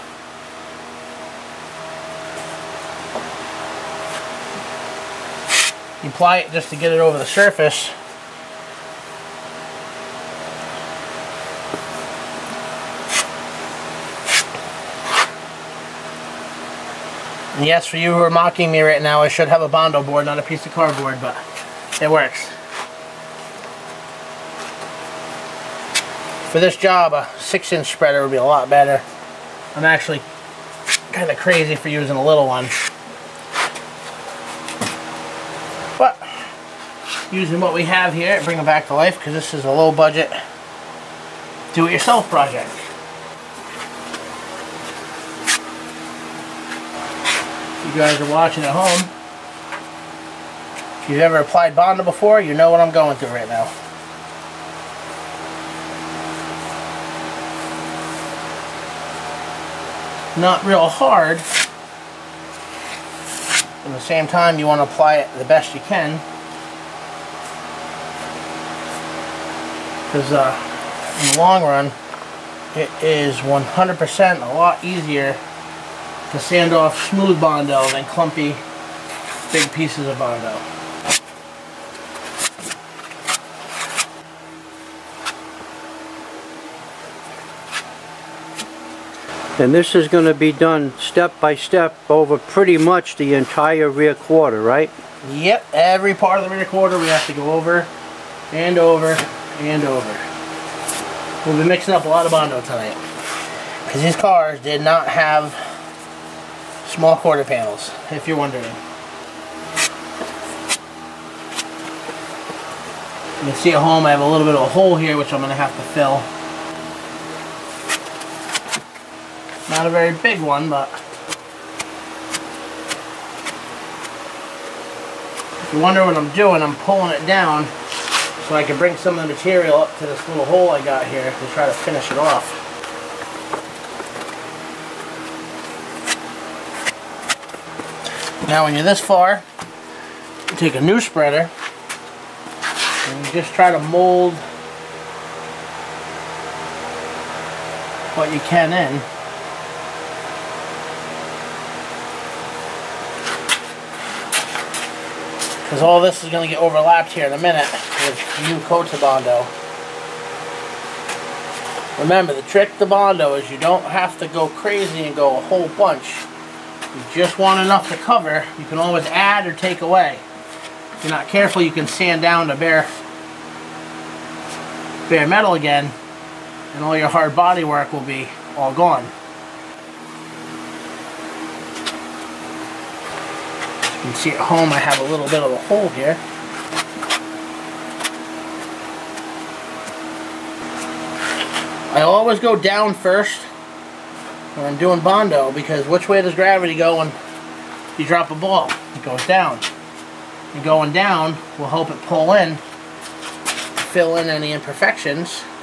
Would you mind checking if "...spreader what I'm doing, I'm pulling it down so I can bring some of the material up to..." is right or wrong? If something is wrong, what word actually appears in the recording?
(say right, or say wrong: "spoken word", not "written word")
wrong: "wonder", not "spreader".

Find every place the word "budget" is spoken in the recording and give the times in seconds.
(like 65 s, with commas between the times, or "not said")
39 s.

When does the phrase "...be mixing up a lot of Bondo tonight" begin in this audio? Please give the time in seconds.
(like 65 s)
101 s.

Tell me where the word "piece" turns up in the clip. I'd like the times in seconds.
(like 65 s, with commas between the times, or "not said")
20 s, 79 s.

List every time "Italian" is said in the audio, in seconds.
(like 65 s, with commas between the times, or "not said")
not said.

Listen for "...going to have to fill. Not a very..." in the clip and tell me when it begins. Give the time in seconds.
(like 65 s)
115 s.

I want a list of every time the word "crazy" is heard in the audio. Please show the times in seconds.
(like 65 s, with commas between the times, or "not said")
31 s, 164 s.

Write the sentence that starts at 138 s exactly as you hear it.
Now when you're this far, you take a new spreader and you just try to mold what you can in.